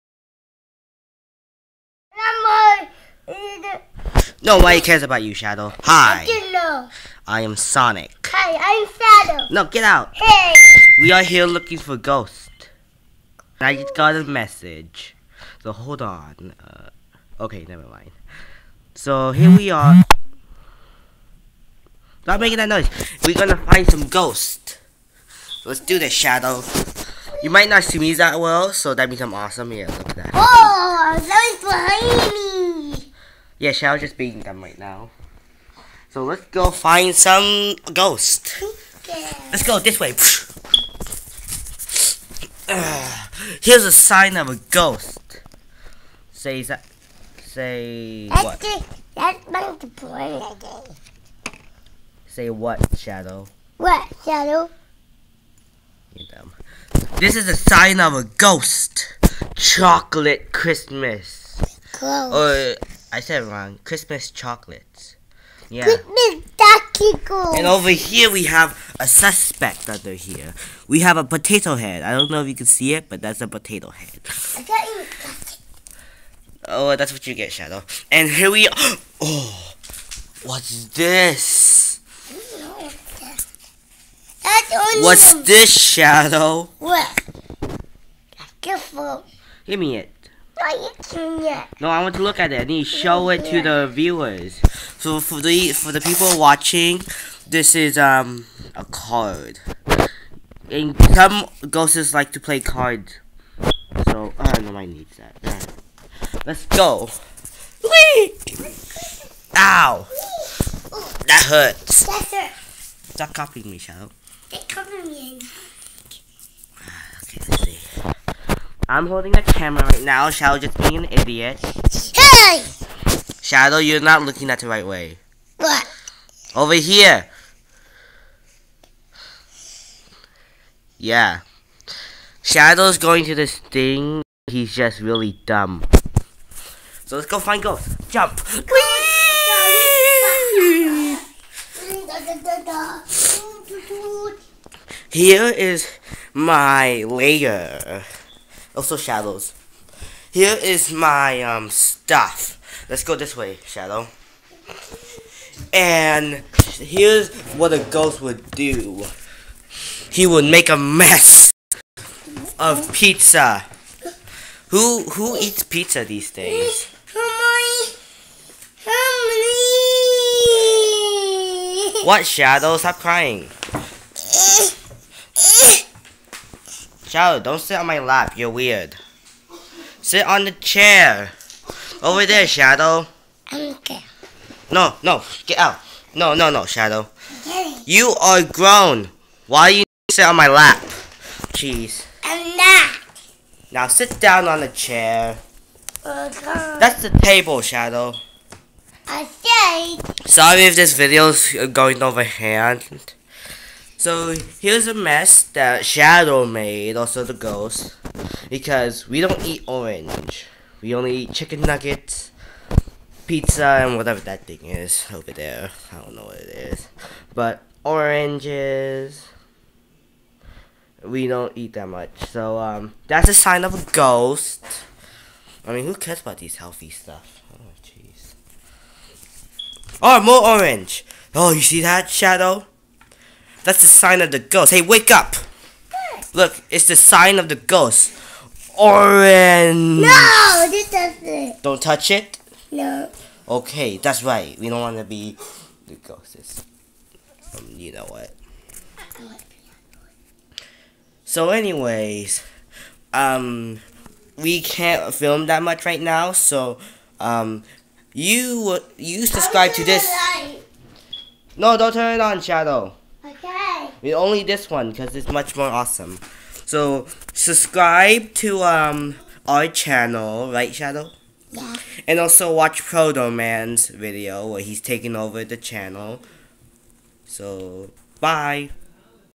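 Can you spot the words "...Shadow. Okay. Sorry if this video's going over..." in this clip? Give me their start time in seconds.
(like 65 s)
197 s.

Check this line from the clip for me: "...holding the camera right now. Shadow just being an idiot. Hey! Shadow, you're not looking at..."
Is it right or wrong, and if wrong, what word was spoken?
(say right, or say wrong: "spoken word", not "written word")
right.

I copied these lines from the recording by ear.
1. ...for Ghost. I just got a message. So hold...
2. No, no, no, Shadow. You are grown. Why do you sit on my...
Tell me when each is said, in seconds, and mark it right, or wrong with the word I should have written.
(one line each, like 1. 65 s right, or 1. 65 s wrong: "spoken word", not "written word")
1. 11 s right
2. 186 s right.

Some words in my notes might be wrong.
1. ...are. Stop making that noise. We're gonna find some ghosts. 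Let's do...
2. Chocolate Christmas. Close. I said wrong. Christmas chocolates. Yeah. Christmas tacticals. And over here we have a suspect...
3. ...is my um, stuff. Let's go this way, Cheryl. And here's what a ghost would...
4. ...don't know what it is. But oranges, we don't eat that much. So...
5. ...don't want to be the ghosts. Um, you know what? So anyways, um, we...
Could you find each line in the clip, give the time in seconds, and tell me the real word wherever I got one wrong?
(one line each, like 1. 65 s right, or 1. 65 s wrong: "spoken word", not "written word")
1. 19 s right
2. 59 s right
3. 150 s wrong: "Shadow", not "Cheryl"
4. 216 s right
5. 244 s right.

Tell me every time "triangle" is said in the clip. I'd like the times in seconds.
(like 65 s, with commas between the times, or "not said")
not said.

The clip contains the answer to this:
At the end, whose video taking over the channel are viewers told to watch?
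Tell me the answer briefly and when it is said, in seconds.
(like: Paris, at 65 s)
Proto Man, at 272 s.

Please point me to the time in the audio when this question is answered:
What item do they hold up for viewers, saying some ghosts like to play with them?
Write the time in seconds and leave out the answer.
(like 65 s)
98 s.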